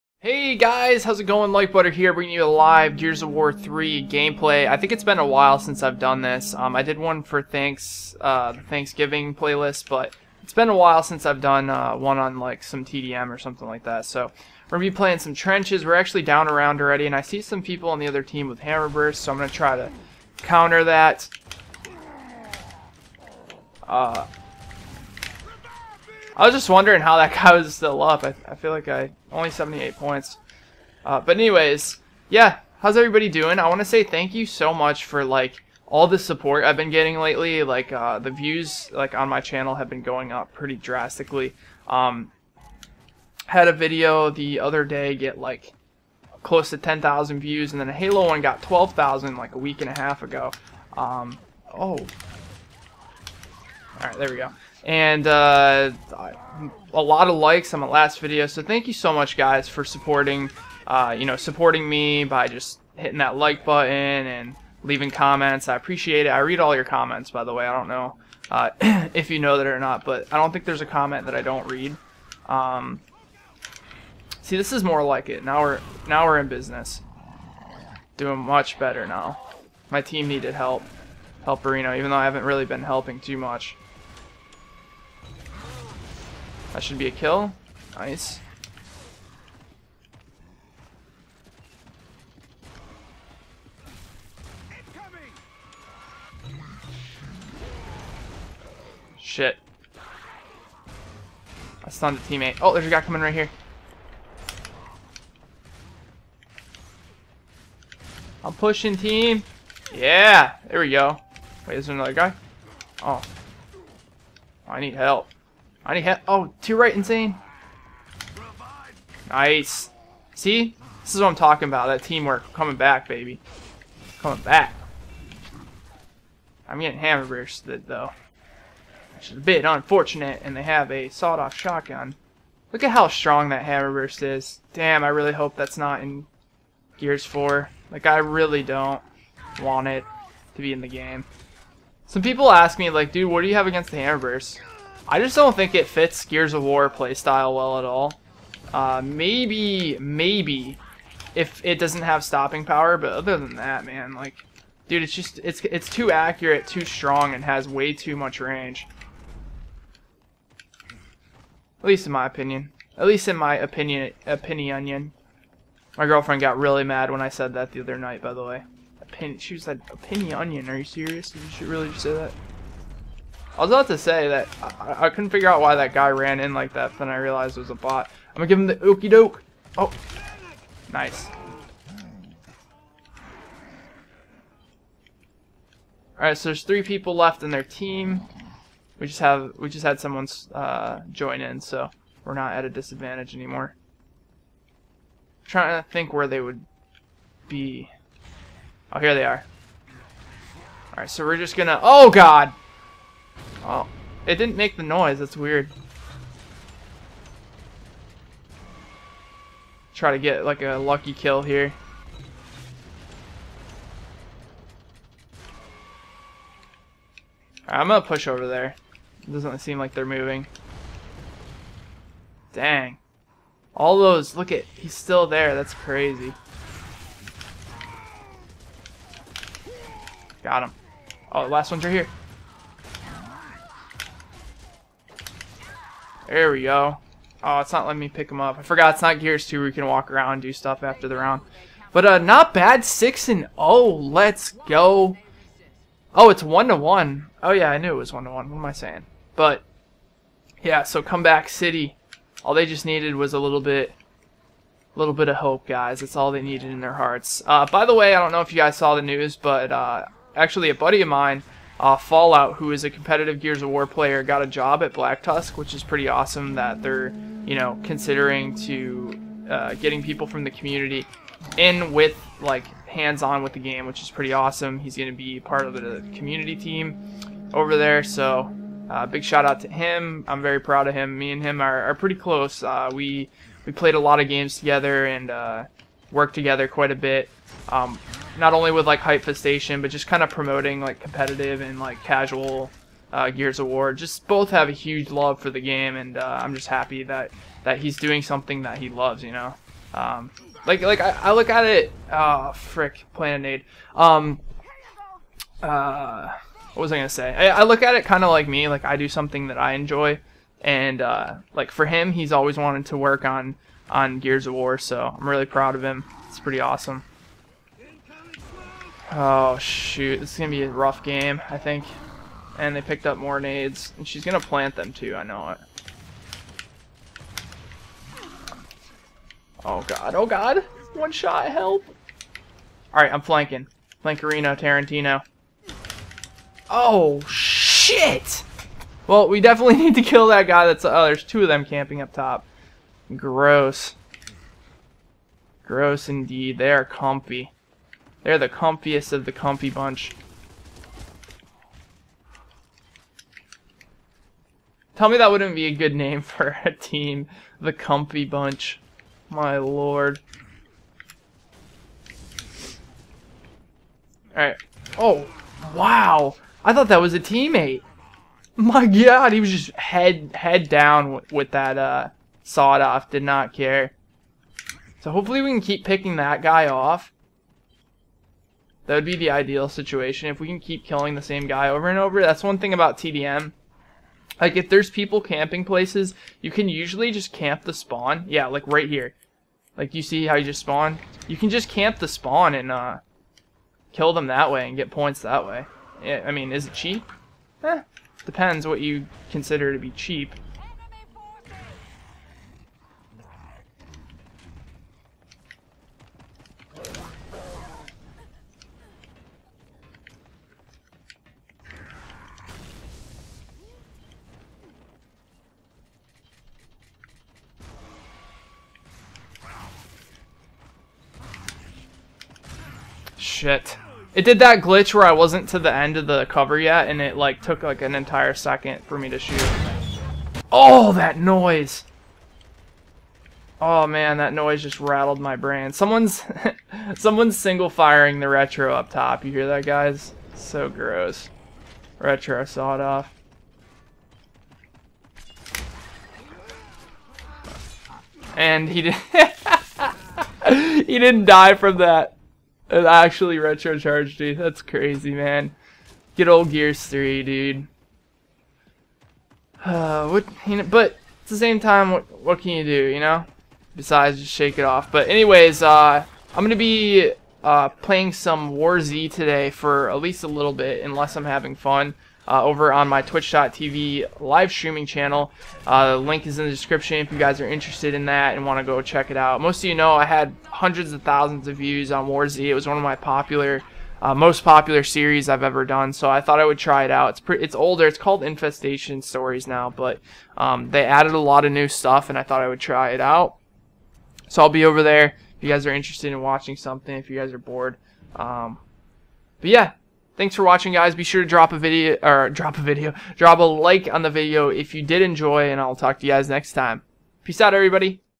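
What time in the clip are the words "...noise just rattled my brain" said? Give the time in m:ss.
7:14.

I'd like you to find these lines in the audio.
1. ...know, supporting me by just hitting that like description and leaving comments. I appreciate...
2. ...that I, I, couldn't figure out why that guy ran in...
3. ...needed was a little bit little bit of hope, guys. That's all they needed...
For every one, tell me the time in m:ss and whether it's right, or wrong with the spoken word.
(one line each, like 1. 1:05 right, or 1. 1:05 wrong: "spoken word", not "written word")
1. 1:01 wrong: "button", not "description"
2. 2:54 right
3. 4:12 right.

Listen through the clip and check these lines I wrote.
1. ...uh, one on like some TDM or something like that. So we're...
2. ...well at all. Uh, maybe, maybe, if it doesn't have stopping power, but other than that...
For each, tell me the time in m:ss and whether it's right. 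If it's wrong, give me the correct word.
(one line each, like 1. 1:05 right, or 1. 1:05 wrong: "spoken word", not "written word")
1. 0:11 right
2. 2:27 right.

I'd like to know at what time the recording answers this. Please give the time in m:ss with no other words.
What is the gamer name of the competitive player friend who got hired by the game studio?
4:21.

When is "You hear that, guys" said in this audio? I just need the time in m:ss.
7:19.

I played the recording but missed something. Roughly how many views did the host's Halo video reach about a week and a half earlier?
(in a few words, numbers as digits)
12,000.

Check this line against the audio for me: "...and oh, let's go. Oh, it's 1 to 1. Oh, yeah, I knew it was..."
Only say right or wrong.
right.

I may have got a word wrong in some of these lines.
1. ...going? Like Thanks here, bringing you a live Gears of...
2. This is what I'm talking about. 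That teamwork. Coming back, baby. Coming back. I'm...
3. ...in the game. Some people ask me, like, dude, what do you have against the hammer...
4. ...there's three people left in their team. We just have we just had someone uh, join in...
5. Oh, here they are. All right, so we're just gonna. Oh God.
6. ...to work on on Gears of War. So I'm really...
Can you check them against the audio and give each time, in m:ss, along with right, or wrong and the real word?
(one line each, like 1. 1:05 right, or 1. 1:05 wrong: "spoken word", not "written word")
1. 0:01 wrong: "Butter", not "Thanks"
2. 2:01 right
3. 2:20 right
4. 3:06 right
5. 3:18 right
6. 5:12 right.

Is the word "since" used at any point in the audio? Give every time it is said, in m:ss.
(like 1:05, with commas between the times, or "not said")
0:05, 0:11.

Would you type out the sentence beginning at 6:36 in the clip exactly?
Yeah, I mean, is it cheap?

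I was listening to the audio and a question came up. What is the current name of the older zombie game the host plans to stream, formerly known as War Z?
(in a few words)
Infestation Stories.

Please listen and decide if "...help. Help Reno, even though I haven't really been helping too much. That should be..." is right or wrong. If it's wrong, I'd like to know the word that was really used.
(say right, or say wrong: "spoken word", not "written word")
right.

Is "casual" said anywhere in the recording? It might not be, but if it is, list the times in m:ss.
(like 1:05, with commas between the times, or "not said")
4:52.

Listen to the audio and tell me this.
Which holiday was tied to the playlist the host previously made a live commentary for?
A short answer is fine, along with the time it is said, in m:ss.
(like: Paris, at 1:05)
Thanksgiving, at 0:08.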